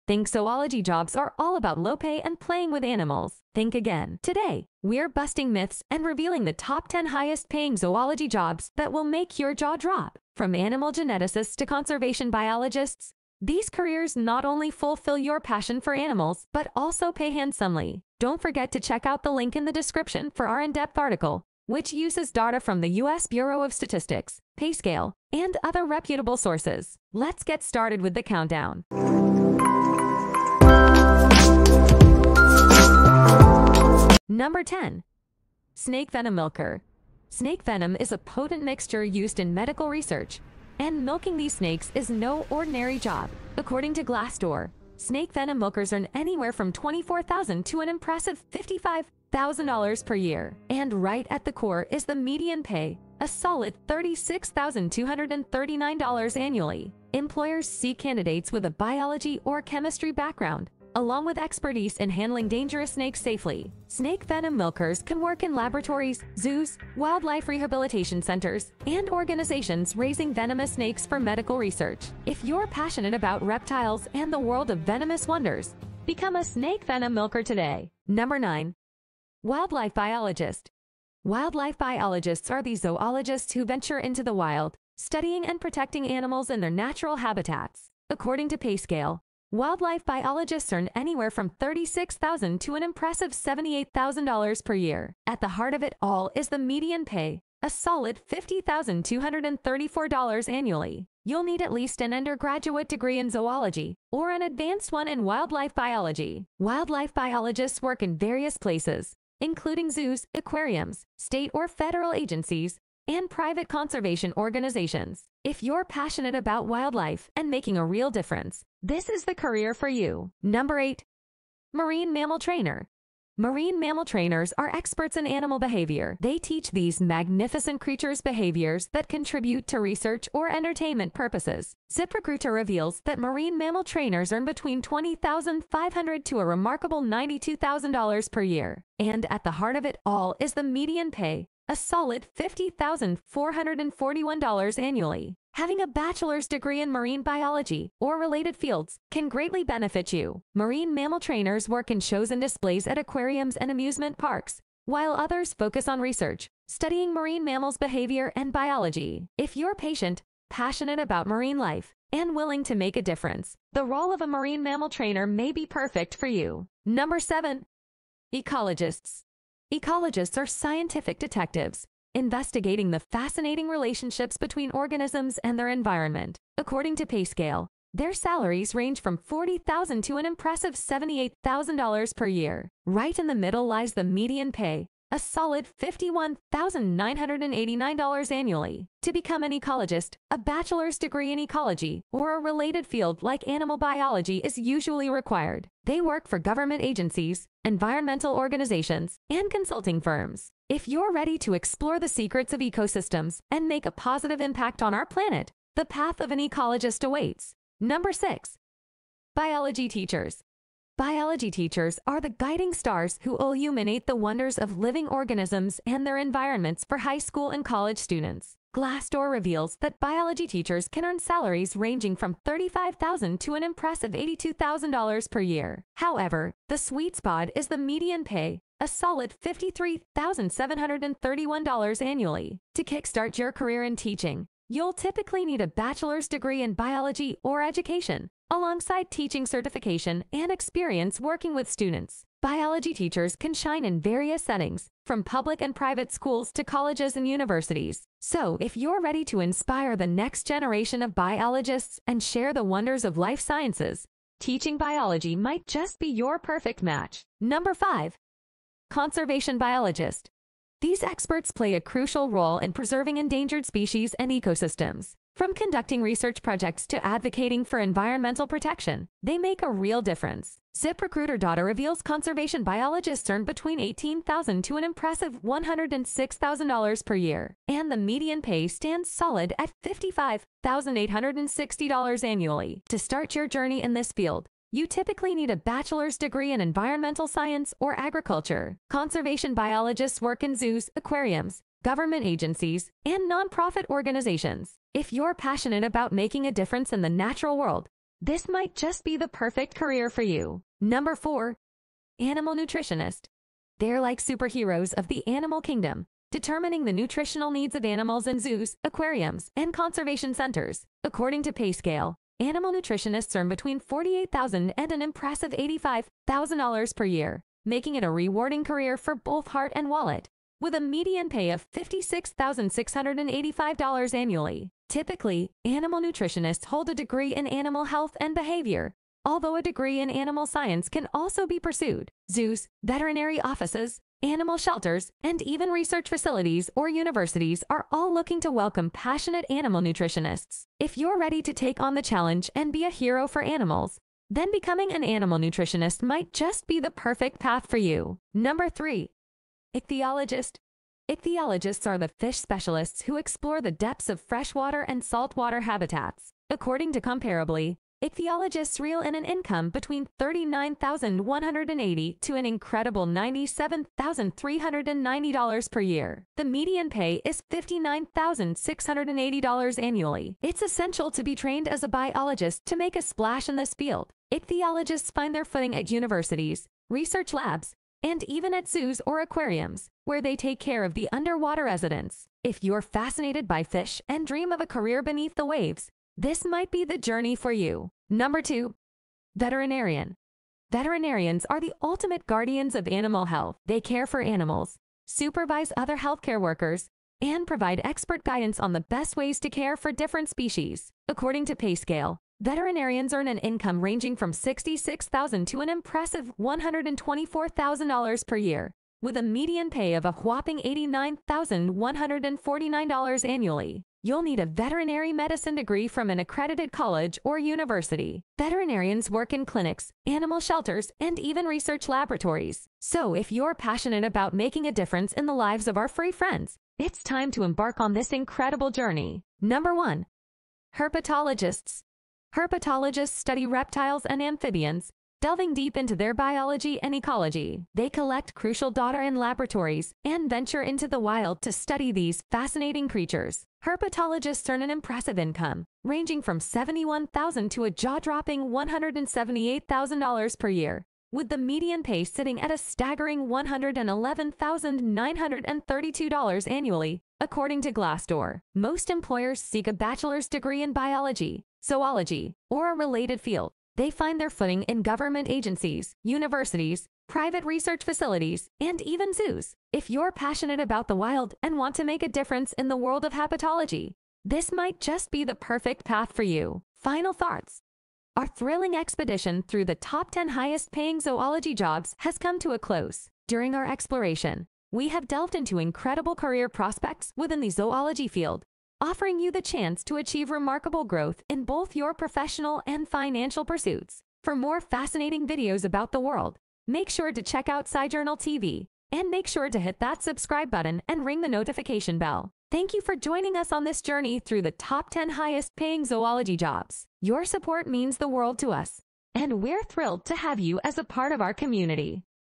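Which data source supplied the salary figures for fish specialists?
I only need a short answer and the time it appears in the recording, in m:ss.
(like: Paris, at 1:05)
Comparably, at 5:56.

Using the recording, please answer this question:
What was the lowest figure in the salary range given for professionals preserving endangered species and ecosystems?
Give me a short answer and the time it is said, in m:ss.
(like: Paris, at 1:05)
$18,000, at 4:33.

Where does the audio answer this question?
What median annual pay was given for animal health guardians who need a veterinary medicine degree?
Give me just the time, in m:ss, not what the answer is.
6:50.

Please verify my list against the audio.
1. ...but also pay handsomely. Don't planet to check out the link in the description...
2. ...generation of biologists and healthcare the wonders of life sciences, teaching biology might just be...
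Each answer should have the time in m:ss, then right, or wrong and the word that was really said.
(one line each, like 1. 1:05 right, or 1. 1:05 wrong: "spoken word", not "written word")
1. 0:16 wrong: "forget", not "planet"
2. 4:10 wrong: "share", not "healthcare".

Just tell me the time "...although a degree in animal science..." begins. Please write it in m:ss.
5:29.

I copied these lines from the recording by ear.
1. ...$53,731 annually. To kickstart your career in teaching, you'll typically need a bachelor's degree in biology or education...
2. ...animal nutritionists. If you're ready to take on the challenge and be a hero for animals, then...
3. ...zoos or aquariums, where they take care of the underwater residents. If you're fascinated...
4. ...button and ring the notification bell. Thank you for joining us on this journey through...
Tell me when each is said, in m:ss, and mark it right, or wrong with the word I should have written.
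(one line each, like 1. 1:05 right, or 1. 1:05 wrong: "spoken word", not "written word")
1. 3:49 right
2. 5:39 right
3. 6:18 right
4. 8:20 right.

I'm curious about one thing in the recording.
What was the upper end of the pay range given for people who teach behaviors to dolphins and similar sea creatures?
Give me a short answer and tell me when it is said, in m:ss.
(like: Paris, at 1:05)
$92,000, at 2:17.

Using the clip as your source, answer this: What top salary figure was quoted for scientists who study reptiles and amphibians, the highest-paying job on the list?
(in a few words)
$178,000.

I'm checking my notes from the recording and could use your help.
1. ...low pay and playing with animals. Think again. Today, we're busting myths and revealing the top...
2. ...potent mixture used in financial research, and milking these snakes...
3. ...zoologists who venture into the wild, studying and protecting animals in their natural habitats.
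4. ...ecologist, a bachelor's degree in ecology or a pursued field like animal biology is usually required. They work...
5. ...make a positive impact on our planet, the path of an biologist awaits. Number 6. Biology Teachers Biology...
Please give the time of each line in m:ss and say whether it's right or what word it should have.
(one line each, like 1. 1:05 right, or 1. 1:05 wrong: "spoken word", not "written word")
1. 0:01 right
2. 0:38 wrong: "medical", not "financial"
3. 1:22 right
4. 3:09 wrong: "related", not "pursued"
5. 3:23 wrong: "ecologist", not "biologist".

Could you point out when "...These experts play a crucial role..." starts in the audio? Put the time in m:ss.
4:20.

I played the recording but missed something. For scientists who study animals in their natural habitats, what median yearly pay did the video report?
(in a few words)
$50,234.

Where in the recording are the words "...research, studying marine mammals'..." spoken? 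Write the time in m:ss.
2:36.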